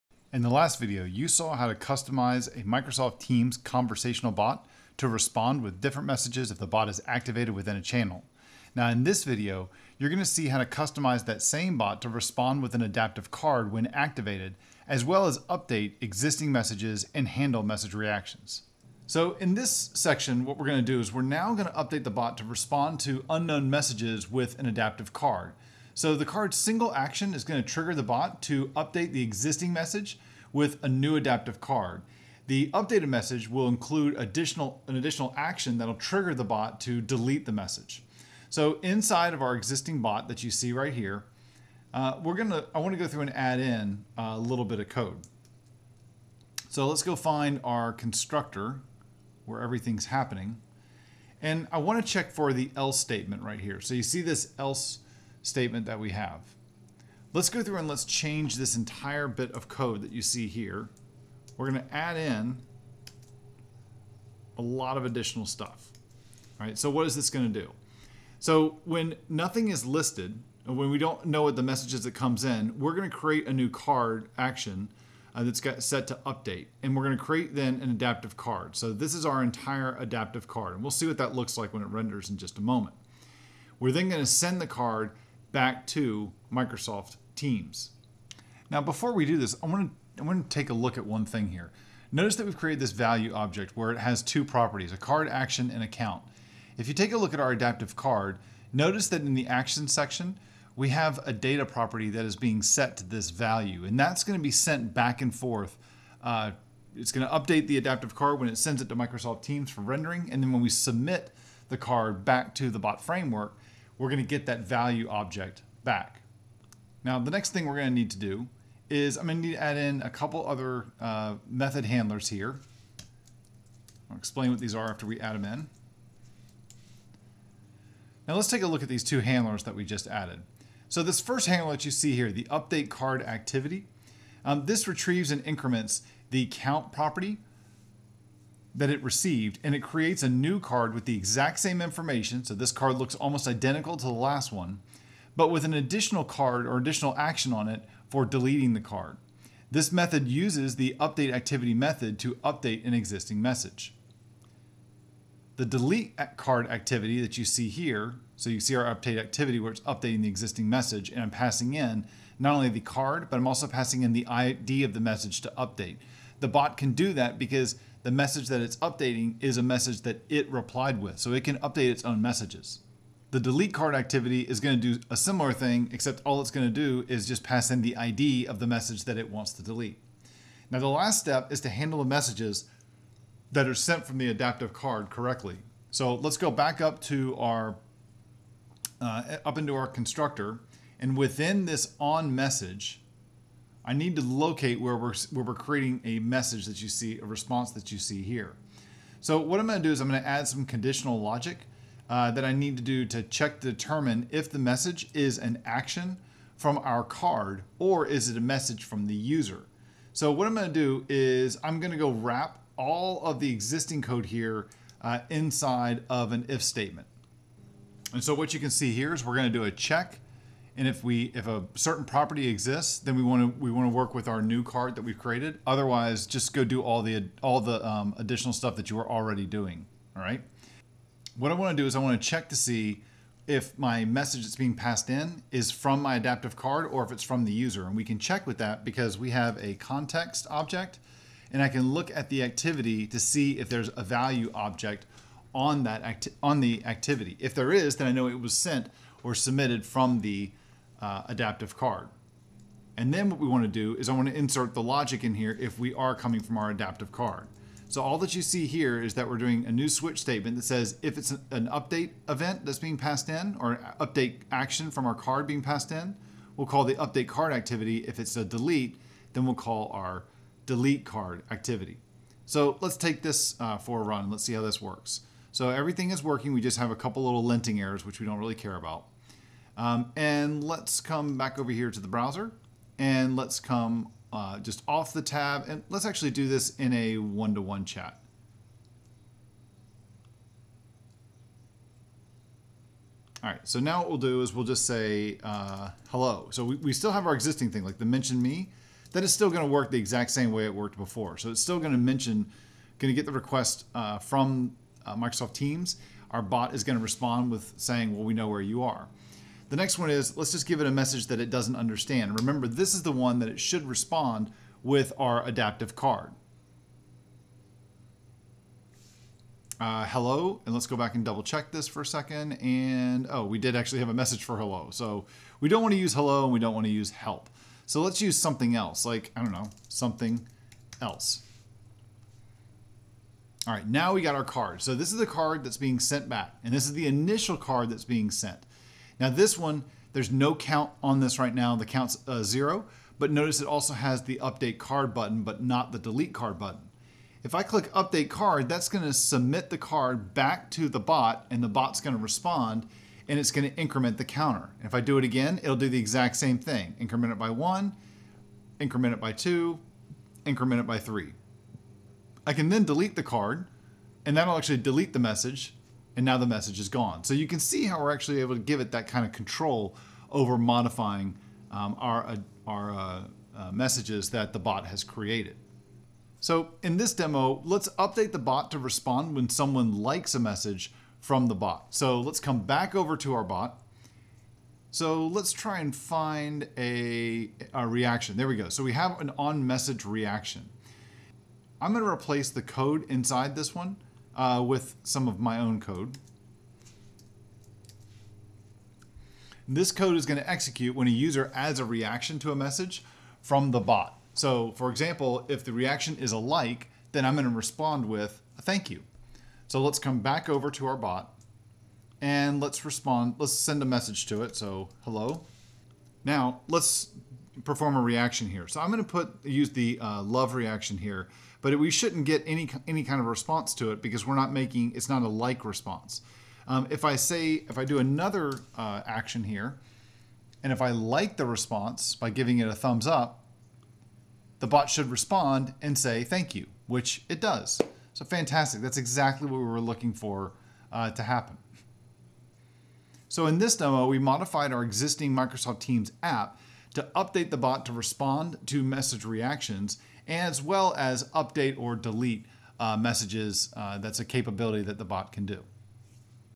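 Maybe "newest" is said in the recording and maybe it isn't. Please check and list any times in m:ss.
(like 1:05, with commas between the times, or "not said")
not said.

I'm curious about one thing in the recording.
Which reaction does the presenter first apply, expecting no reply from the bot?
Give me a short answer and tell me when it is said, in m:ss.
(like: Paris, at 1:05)
love, at 7:00.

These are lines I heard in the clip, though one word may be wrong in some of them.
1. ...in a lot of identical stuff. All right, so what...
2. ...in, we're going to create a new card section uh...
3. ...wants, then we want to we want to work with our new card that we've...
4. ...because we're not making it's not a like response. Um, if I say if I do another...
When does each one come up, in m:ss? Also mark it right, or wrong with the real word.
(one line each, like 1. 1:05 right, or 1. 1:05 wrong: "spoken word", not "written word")
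1. 1:02 wrong: "additional", not "identical"
2. 1:12 wrong: "action", not "section"
3. 3:42 wrong: "exists", not "wants"
4. 7:04 right.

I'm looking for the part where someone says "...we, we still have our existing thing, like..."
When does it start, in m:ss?
4:56.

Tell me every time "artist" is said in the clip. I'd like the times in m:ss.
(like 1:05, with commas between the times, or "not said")
not said.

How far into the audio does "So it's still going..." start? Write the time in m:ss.
5:01.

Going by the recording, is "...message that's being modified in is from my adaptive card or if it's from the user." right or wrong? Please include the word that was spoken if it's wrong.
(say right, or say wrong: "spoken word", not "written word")
wrong: "passed", not "modified".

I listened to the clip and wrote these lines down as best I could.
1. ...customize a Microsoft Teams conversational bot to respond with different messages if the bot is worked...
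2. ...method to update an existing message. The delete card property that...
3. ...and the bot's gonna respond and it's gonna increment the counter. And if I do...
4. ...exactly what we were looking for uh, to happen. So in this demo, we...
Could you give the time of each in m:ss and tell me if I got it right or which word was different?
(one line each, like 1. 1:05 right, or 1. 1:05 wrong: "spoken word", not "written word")
1. 0:01 wrong: "activated", not "worked"
2. 2:31 wrong: "activity", not "property"
3. 5:51 right
4. 7:18 right.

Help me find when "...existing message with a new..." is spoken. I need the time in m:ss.
0:29.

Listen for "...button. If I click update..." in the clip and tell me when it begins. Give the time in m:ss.
5:46.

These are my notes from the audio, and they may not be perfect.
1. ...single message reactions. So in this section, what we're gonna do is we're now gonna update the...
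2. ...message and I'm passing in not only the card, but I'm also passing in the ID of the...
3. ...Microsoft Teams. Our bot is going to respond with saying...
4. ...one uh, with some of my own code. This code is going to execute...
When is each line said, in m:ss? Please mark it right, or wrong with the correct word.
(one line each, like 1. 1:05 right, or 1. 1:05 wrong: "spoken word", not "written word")
1. 0:17 wrong: "handle", not "single"
2. 2:40 right
3. 5:05 right
4. 6:33 right.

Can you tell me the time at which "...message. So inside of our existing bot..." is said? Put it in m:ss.
0:37.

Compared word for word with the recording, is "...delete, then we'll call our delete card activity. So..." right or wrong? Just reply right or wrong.
right.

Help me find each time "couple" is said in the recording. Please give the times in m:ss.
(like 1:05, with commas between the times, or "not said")
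2:00, 4:36.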